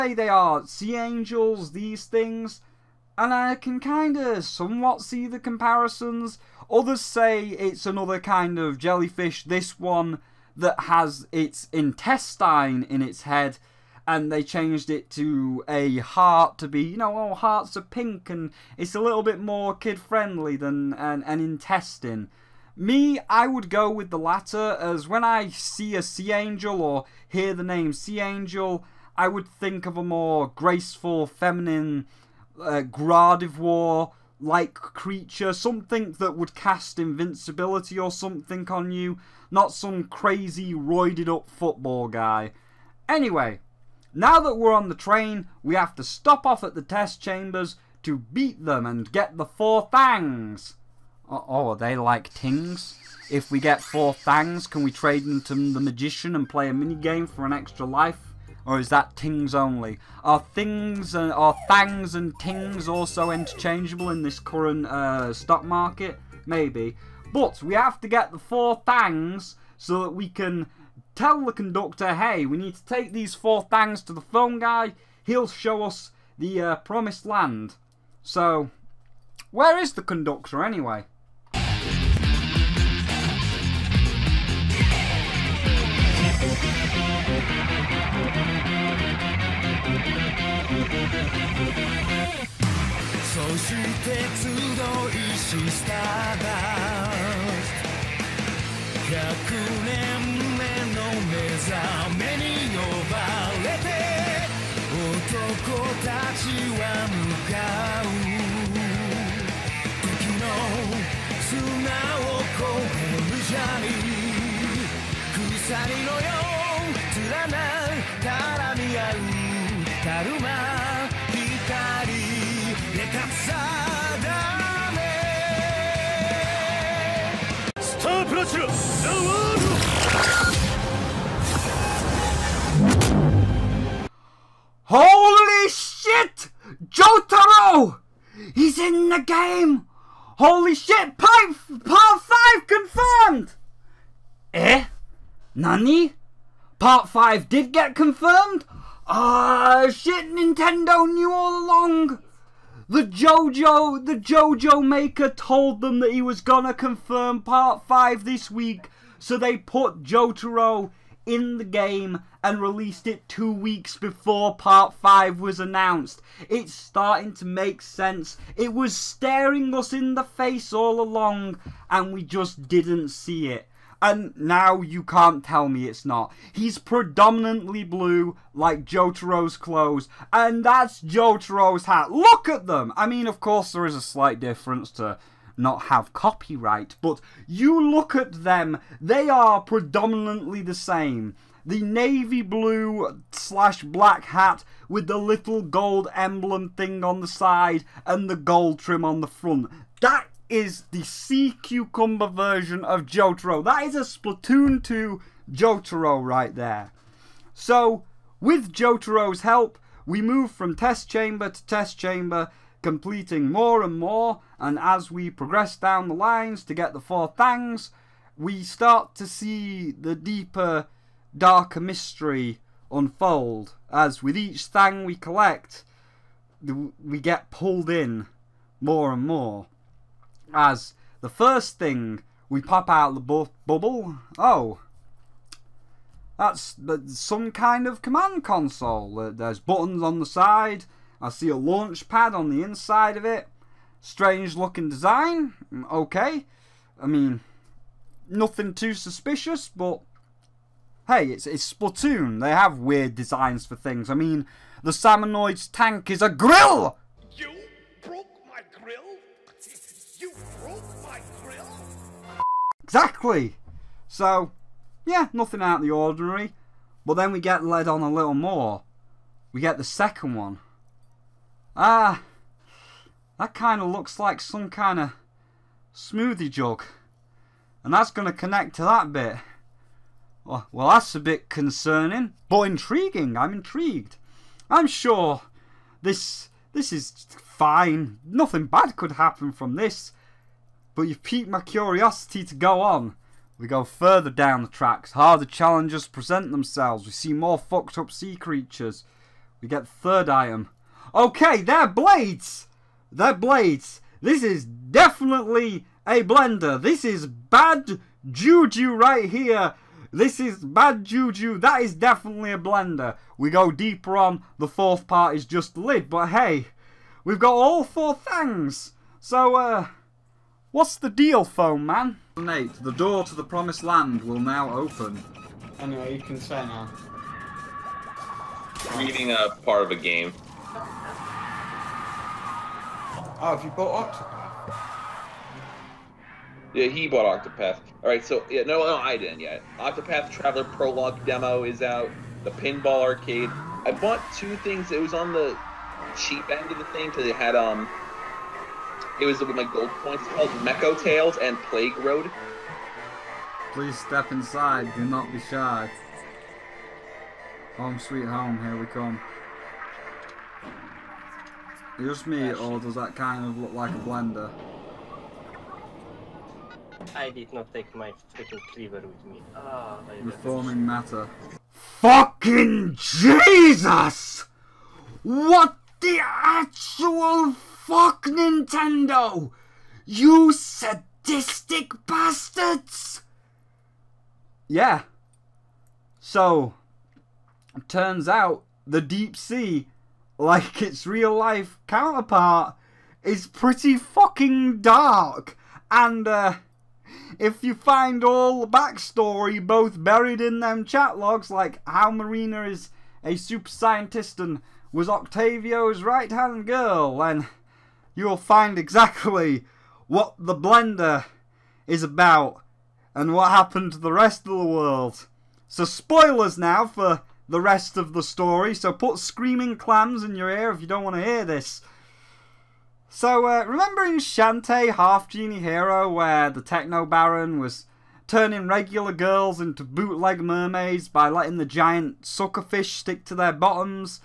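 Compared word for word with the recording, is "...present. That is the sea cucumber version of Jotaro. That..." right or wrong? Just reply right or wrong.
wrong.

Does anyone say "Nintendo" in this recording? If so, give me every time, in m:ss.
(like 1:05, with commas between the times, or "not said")
2:30, 6:18.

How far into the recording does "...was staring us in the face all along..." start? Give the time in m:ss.
2:48.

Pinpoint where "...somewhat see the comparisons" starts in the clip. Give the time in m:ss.
0:04.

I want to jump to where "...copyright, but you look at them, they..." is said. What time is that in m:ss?
3:06.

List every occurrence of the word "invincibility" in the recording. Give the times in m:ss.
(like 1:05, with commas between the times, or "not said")
0:36.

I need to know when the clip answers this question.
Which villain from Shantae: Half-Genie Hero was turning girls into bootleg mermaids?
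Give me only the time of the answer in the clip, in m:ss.
7:06.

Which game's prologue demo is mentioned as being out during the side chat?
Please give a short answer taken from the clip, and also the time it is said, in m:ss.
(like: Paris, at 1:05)
Octopath Traveler, at 5:39.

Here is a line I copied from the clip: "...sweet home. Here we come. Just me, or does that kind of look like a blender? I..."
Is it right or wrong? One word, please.
right.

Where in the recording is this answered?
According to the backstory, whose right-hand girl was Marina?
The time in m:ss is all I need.
6:45.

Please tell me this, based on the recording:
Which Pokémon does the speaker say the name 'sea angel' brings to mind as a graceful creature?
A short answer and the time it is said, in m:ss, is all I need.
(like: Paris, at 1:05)
Gardevoir, at 0:32.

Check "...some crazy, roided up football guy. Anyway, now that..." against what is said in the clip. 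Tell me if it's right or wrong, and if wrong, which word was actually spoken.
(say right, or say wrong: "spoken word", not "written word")
right.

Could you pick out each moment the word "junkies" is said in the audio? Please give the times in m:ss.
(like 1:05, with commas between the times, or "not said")
not said.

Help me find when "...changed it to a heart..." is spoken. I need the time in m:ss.
0:14.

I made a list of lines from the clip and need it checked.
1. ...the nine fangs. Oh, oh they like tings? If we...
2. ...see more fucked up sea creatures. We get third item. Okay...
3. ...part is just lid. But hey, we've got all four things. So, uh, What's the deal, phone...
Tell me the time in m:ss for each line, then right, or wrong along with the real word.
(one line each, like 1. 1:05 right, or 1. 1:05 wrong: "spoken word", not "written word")
1. 0:49 wrong: "four", not "nine"
2. 4:57 right
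3. 5:15 right.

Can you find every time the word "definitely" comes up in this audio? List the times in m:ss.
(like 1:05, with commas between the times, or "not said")
5:04, 5:11.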